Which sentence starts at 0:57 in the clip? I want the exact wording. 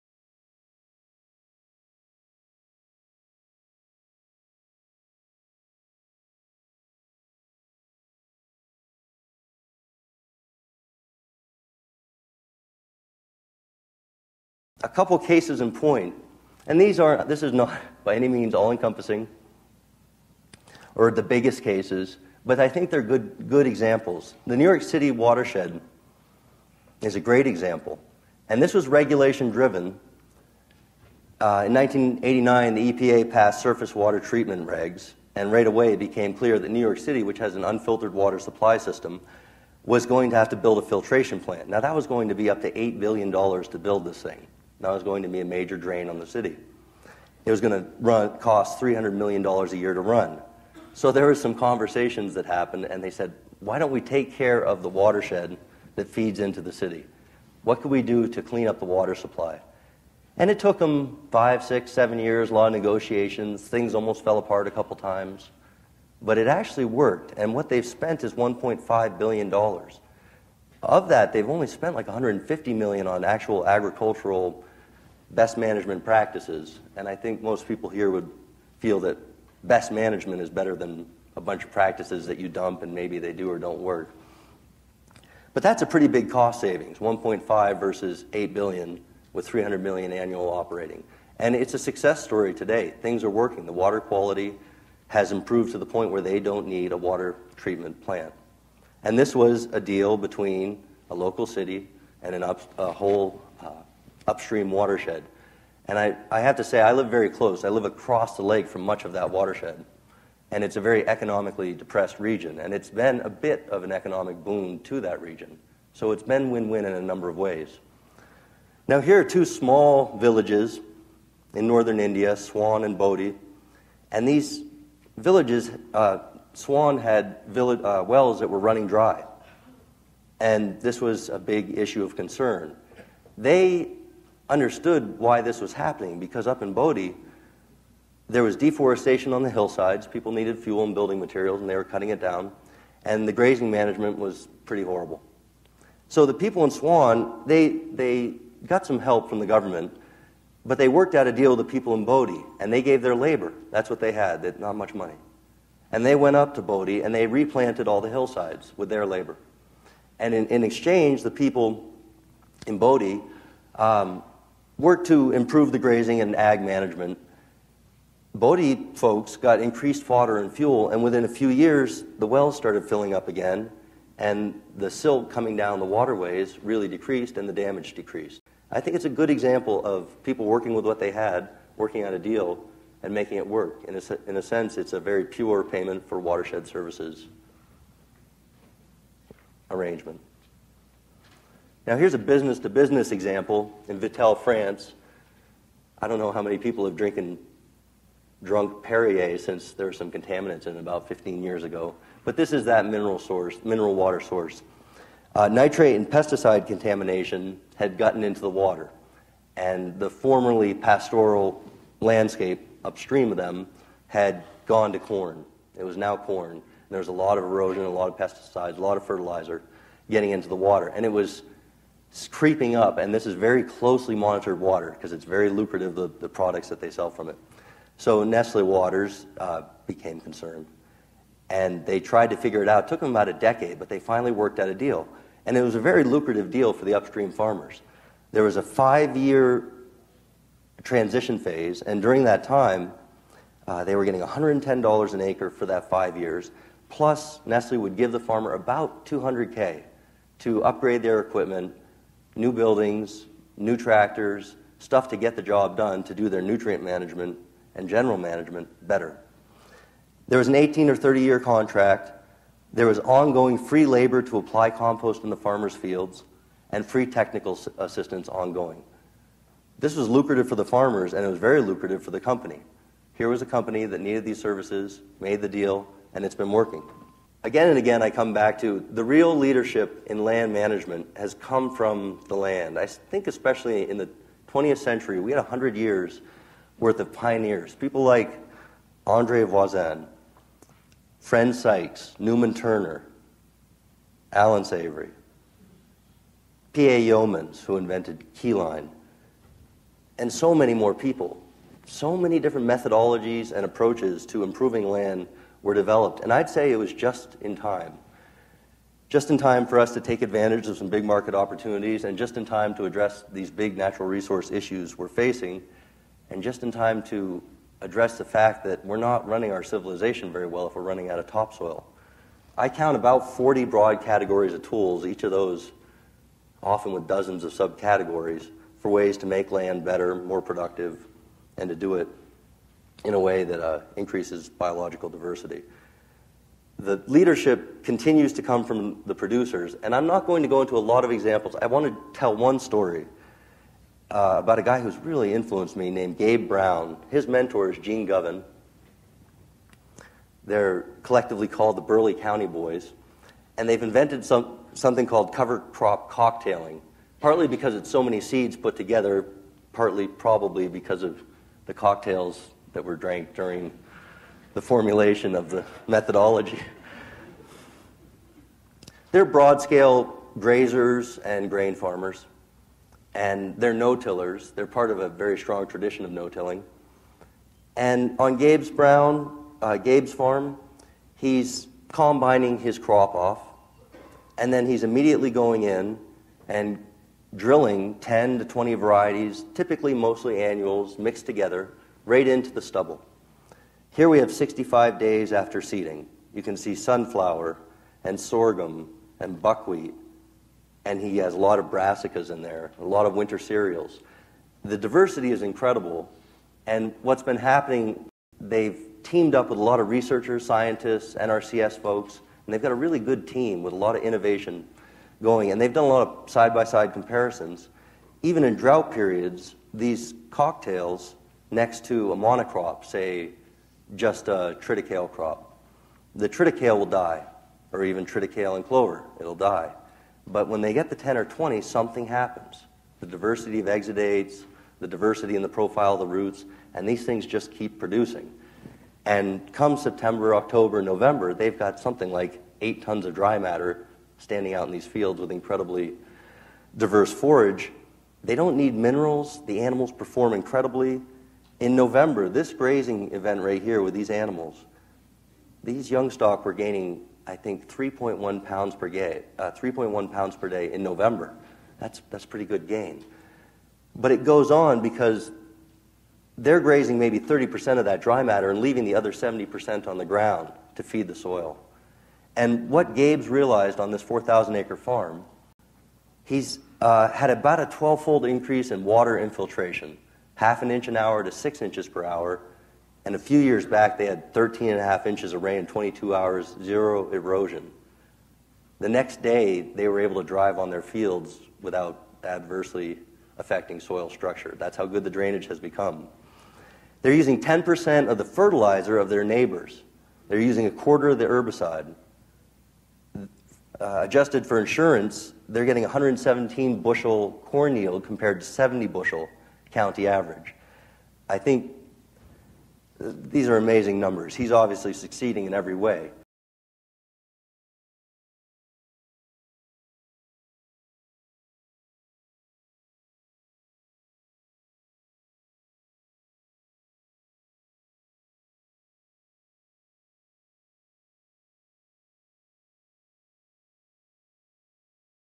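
What could we do to clean up the water supply?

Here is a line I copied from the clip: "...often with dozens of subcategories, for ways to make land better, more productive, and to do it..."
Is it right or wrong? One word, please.
right.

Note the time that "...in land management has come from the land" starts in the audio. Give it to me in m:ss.
4:40.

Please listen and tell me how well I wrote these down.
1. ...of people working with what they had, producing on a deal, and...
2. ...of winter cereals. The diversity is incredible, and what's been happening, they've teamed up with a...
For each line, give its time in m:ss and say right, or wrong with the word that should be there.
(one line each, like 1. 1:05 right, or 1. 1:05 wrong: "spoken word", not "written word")
1. 2:59 wrong: "working", not "producing"
2. 6:43 right.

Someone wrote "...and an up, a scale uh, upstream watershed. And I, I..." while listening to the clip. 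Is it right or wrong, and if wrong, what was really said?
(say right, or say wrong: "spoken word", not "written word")
wrong: "whole", not "scale".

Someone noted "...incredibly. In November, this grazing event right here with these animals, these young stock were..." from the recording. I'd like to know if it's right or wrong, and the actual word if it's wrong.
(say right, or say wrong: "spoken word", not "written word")
right.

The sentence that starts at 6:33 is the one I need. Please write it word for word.
Here we have 65 days after seeding.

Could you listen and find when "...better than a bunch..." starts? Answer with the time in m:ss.
1:20.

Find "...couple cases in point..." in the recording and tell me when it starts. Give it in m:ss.
0:14.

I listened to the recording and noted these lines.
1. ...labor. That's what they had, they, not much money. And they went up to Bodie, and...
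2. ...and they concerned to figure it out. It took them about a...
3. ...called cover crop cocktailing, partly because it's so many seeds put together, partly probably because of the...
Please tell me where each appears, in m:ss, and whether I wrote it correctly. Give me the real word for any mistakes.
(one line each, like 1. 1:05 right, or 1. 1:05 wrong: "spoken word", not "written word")
1. 2:33 right
2. 3:51 wrong: "tried", not "concerned"
3. 5:55 right.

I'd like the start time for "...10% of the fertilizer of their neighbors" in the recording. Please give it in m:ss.
8:17.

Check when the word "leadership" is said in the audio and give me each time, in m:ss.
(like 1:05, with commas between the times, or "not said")
4:39, 5:37.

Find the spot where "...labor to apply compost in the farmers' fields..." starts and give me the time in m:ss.
4:23.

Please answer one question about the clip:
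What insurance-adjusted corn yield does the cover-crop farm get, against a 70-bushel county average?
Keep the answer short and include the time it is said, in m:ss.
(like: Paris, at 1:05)
117 bushels, at 8:25.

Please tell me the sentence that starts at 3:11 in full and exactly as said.
Now, here's a business to business example in Vittel, France.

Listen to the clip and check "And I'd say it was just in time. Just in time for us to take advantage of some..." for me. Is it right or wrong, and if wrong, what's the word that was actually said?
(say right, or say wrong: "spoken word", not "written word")
right.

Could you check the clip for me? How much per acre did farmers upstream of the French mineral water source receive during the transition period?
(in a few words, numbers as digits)
$110.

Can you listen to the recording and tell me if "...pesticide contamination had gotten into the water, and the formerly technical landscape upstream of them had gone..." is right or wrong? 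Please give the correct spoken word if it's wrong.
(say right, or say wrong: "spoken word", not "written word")
wrong: "pastoral", not "technical".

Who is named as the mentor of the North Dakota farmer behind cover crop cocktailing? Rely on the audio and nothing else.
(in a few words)
Gene Govan.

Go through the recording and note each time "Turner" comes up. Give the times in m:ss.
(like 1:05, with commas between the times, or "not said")
4:52.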